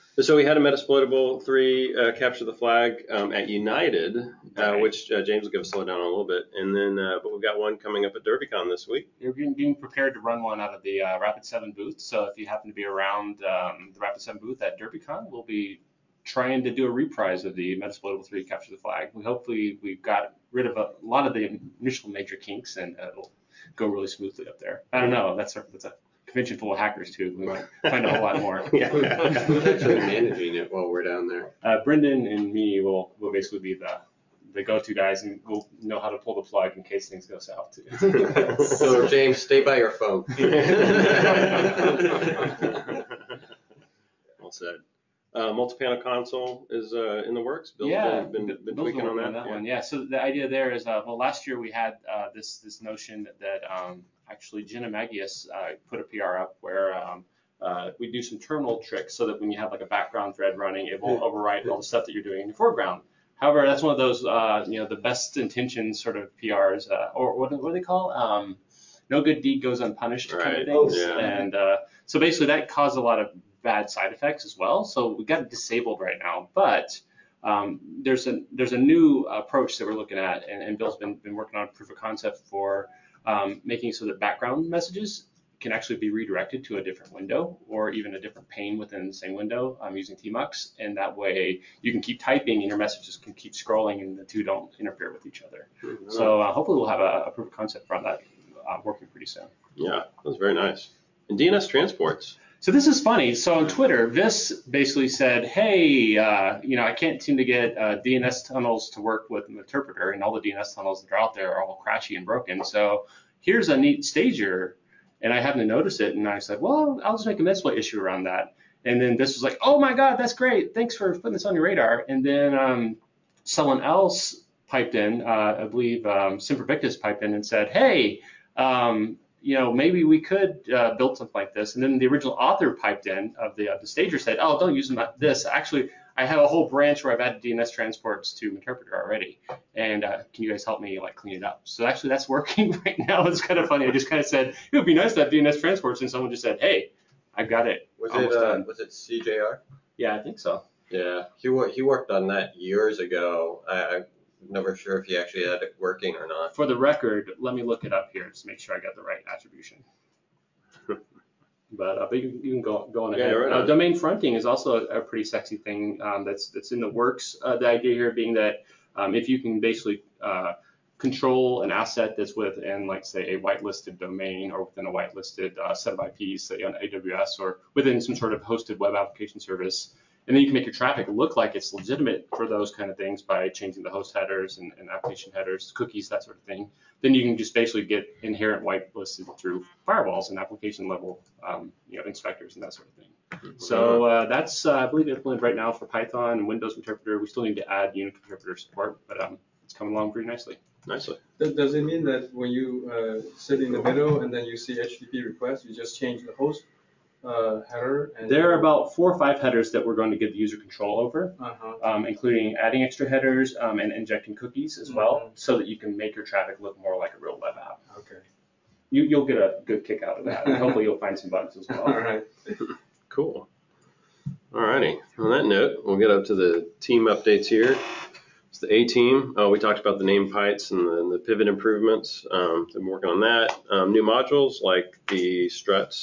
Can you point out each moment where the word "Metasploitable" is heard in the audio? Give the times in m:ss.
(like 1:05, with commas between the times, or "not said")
0:00, 0:17.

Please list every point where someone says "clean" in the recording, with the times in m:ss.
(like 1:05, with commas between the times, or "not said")
2:21.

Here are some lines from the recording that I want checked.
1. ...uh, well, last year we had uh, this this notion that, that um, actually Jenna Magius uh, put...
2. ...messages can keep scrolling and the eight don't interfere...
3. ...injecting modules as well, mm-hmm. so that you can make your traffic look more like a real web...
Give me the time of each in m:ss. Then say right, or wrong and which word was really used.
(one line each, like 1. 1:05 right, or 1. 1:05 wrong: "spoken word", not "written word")
1. 0:50 right
2. 1:32 wrong: "two", not "eight"
3. 3:33 wrong: "cookies", not "modules".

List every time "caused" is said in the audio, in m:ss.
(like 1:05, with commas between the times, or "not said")
1:12.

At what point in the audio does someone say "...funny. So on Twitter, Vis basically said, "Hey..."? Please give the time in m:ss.
1:43.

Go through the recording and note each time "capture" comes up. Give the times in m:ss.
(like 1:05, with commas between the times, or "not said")
0:02, 0:18.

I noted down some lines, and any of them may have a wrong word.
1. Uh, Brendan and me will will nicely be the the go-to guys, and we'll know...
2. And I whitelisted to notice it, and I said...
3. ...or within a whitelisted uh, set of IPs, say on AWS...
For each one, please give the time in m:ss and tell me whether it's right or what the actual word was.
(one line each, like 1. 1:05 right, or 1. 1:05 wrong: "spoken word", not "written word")
1. 0:31 wrong: "basically", not "nicely"
2. 1:55 wrong: "happened", not "whitelisted"
3. 2:54 right.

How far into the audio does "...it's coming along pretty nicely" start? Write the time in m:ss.
3:19.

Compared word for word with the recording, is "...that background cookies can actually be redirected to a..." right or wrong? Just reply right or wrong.
wrong.